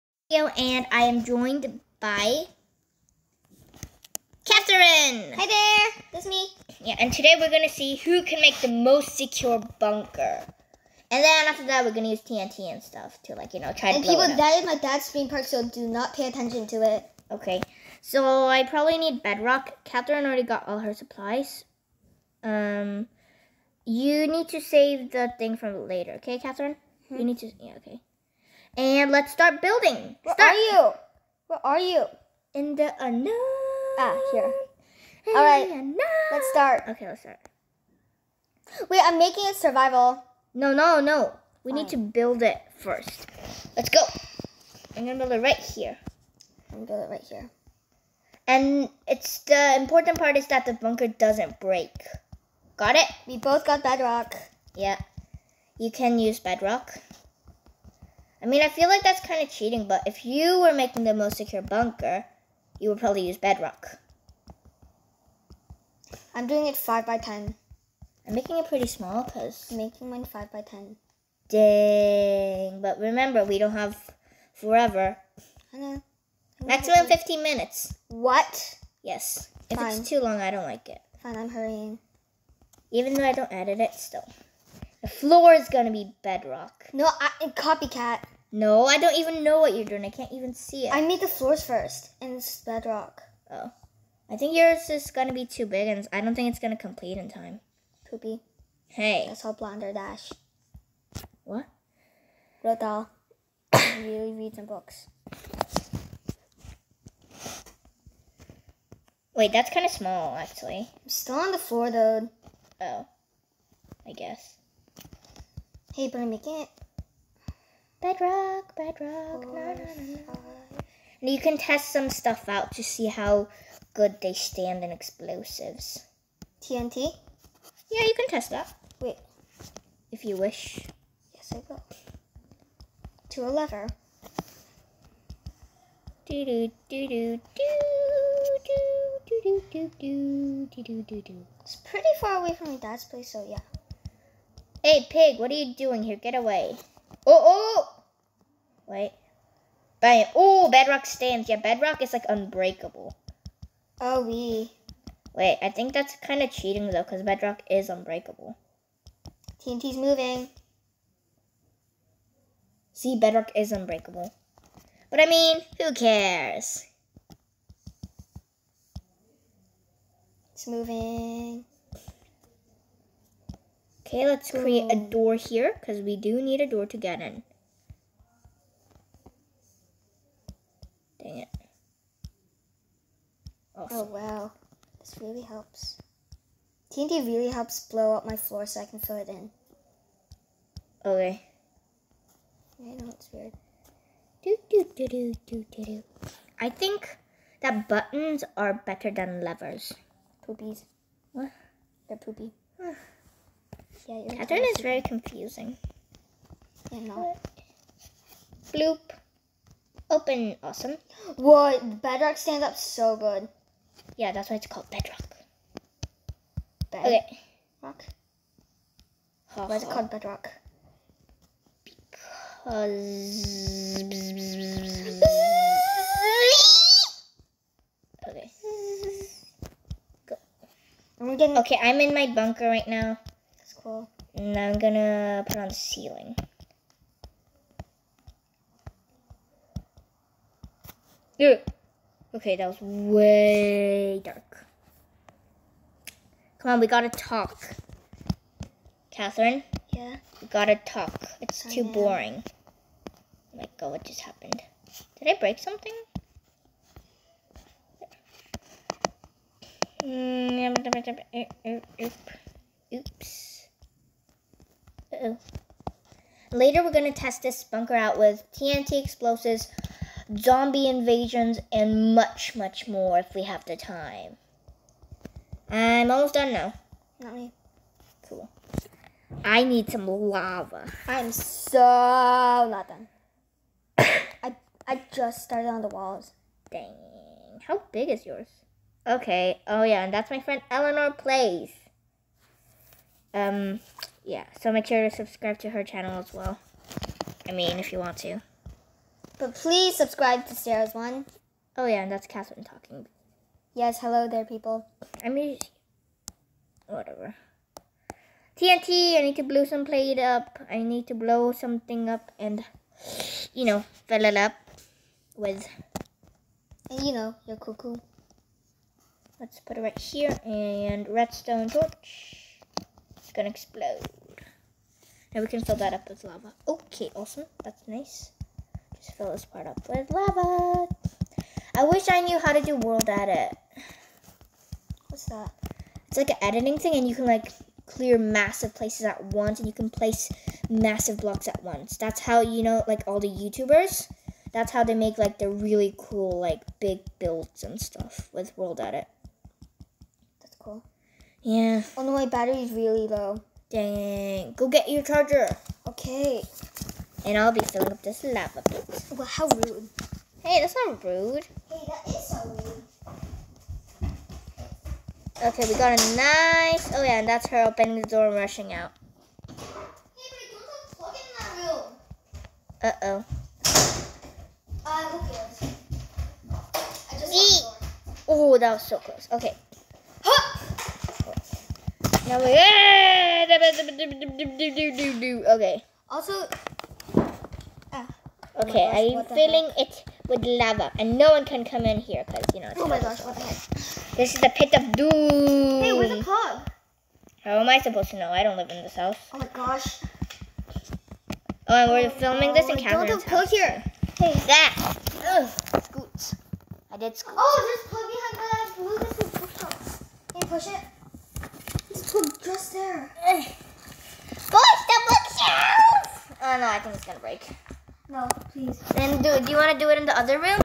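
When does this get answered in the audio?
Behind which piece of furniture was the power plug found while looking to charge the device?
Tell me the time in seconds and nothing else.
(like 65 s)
415 s.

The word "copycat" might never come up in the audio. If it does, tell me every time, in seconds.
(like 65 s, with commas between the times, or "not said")
87 s.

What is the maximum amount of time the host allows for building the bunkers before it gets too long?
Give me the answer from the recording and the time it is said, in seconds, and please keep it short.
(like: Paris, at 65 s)
15 minutes, at 76 s.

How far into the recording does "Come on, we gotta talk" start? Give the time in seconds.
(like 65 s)
246 s.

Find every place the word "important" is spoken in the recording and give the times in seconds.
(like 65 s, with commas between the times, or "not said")
49 s.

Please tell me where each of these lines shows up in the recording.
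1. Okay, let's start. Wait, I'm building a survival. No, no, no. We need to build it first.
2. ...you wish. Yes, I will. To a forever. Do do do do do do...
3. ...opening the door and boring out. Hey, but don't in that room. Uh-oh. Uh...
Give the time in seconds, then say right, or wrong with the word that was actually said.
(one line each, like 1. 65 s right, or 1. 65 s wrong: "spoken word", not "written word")
1. 36 s wrong: "making", not "building"
2. 130 s wrong: "lever", not "forever"
3. 367 s wrong: "rushing", not "boring".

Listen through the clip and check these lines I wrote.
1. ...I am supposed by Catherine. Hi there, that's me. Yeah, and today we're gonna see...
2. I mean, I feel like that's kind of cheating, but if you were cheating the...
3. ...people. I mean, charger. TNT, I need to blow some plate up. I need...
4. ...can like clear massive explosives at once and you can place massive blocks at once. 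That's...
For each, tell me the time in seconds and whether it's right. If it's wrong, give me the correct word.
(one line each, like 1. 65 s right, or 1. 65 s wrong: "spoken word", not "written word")
1. 0 s wrong: "joined", not "supposed"
2. 58 s wrong: "making", not "cheating"
3. 304 s wrong: "whatever", not "charger"
4. 337 s wrong: "places", not "explosives".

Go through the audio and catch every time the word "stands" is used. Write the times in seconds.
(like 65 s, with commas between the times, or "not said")
124 s, 151 s, 212 s.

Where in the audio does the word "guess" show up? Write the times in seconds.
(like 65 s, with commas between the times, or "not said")
114 s.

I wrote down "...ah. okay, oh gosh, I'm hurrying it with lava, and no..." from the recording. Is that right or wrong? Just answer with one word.
wrong.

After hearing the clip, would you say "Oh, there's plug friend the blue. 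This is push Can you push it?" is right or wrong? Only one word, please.
wrong.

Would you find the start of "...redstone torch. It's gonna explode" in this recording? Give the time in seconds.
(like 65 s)
321 s.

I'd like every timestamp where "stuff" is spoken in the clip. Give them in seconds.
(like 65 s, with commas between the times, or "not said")
12 s, 122 s, 347 s.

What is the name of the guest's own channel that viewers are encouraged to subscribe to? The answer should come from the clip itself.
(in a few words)
Eleanor Plays.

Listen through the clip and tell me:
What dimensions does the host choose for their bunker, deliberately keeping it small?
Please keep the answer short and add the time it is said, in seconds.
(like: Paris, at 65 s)
5 by 10, at 66 s.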